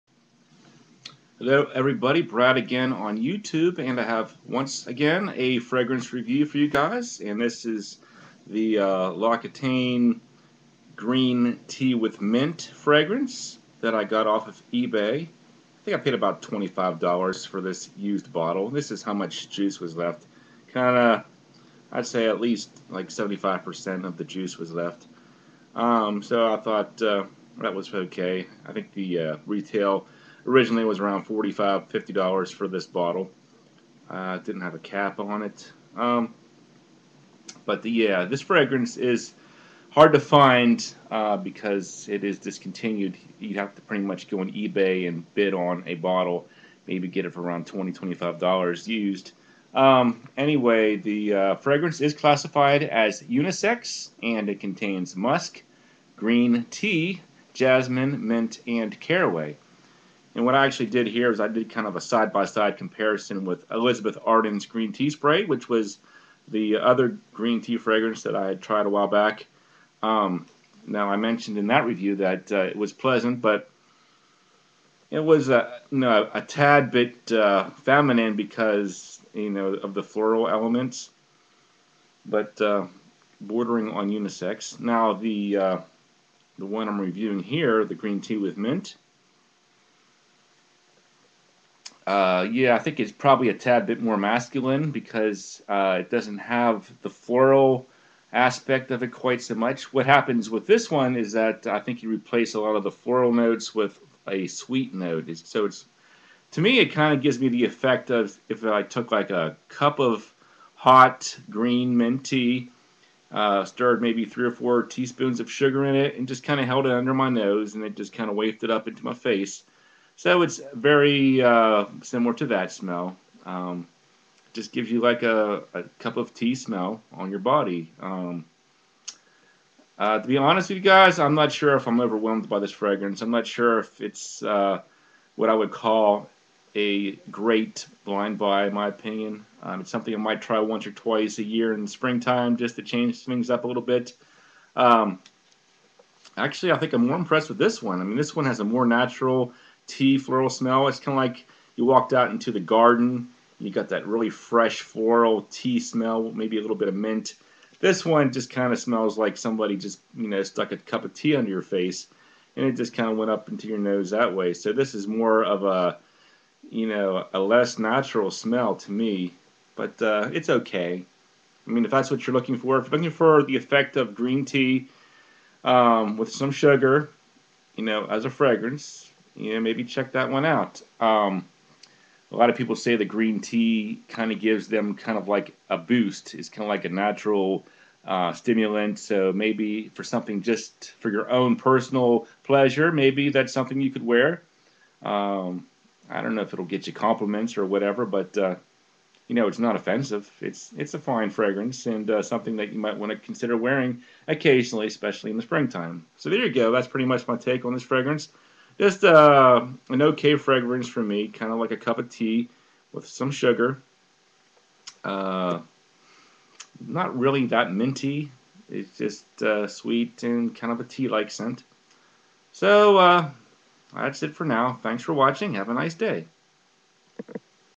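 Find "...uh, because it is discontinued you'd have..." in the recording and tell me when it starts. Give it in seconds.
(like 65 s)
41 s.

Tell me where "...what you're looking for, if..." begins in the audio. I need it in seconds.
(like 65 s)
172 s.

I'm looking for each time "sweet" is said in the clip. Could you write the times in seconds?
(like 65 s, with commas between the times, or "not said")
104 s, 219 s.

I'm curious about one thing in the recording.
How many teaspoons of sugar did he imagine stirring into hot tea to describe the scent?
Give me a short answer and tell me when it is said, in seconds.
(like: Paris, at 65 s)
3 or 4, at 114 s.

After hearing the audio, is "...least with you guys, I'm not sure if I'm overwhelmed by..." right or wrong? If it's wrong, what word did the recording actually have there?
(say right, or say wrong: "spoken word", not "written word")
wrong: "honest", not "least".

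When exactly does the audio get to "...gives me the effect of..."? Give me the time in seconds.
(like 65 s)
107 s.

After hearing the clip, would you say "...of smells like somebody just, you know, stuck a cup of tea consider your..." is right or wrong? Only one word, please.
wrong.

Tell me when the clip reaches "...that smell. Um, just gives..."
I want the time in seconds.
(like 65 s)
122 s.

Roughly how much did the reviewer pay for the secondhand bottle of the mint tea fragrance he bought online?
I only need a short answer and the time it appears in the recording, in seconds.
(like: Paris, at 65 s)
$25, at 16 s.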